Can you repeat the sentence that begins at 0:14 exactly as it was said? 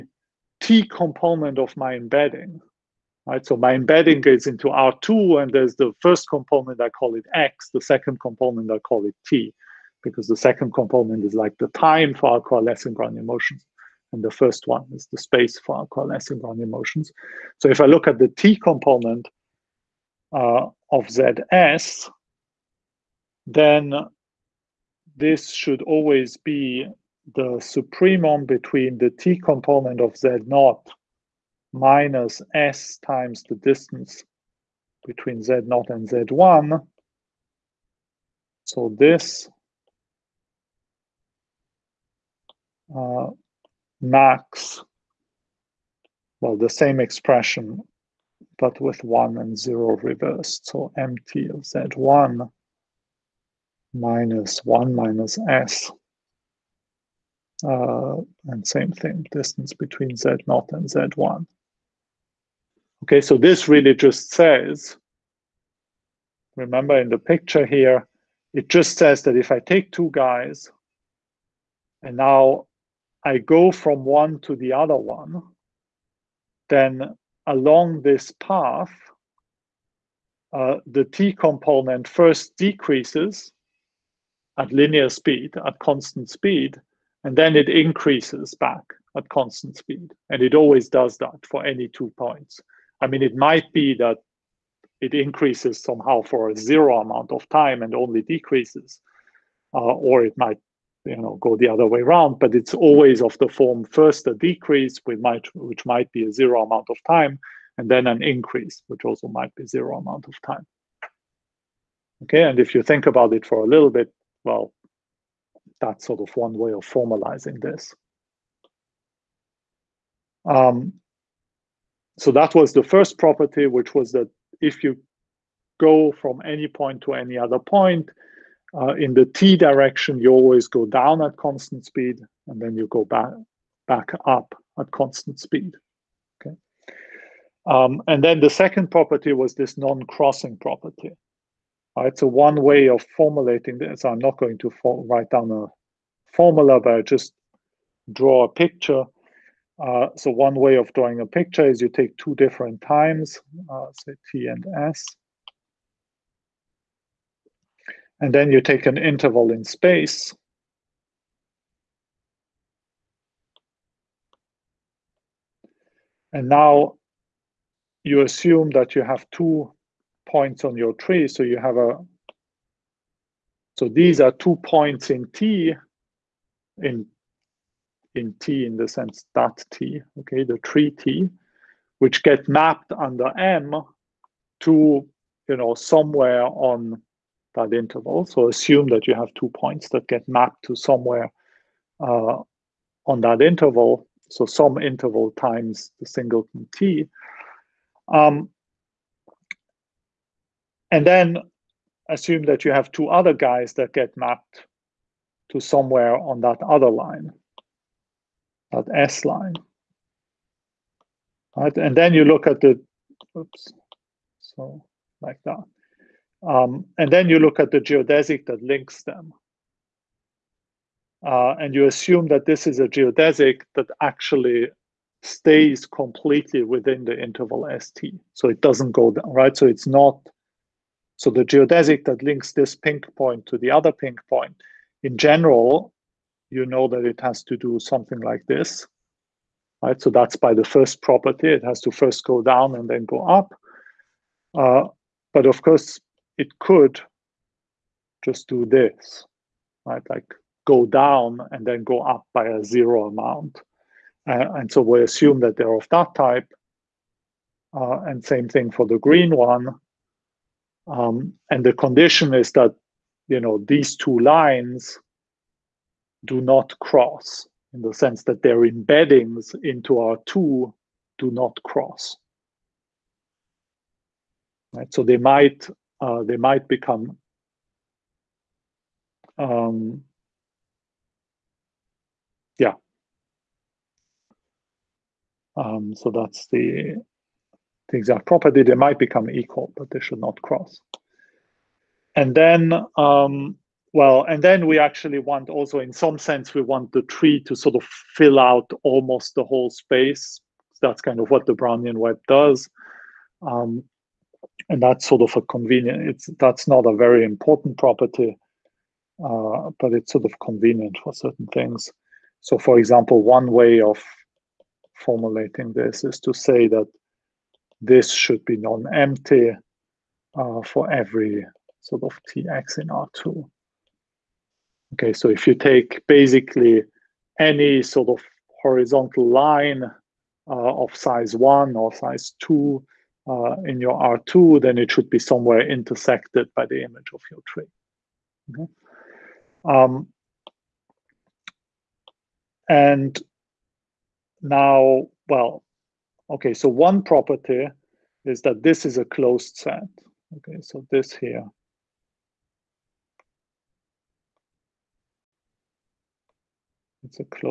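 And the first one is the space for our coalescing Brownian motions.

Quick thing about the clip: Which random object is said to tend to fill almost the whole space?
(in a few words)
the Brownian web.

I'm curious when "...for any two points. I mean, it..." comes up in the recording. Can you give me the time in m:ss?
1:31.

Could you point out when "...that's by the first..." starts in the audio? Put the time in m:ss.
4:00.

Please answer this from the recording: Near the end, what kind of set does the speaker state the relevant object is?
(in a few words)
a closed set.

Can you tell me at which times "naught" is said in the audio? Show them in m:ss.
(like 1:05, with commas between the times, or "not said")
0:30, 0:35.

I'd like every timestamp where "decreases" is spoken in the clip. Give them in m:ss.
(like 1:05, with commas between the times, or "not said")
1:22, 1:38, 1:44.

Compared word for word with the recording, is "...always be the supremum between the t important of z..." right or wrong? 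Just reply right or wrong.
wrong.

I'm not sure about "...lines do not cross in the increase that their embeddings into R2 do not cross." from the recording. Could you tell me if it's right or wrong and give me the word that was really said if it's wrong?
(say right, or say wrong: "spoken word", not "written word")
wrong: "sense", not "increase".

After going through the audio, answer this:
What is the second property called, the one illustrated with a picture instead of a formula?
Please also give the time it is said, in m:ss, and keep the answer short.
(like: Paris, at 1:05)
non-crossing property, at 2:19.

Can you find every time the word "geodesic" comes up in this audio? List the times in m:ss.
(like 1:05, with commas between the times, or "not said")
3:37, 3:42, 3:51.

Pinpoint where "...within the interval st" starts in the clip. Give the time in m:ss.
3:46.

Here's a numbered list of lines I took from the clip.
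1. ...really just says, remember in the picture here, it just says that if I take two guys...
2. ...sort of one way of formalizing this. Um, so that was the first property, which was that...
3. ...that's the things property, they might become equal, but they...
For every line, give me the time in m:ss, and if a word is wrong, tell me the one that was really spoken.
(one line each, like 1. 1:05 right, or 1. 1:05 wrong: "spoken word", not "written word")
1. 1:03 right
2. 1:56 right
3. 4:46 right.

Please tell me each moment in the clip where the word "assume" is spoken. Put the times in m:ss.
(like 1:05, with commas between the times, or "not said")
2:48, 3:08, 3:22, 3:41, 4:15.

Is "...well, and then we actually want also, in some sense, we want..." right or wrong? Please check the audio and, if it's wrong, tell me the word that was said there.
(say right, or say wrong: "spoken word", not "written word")
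right.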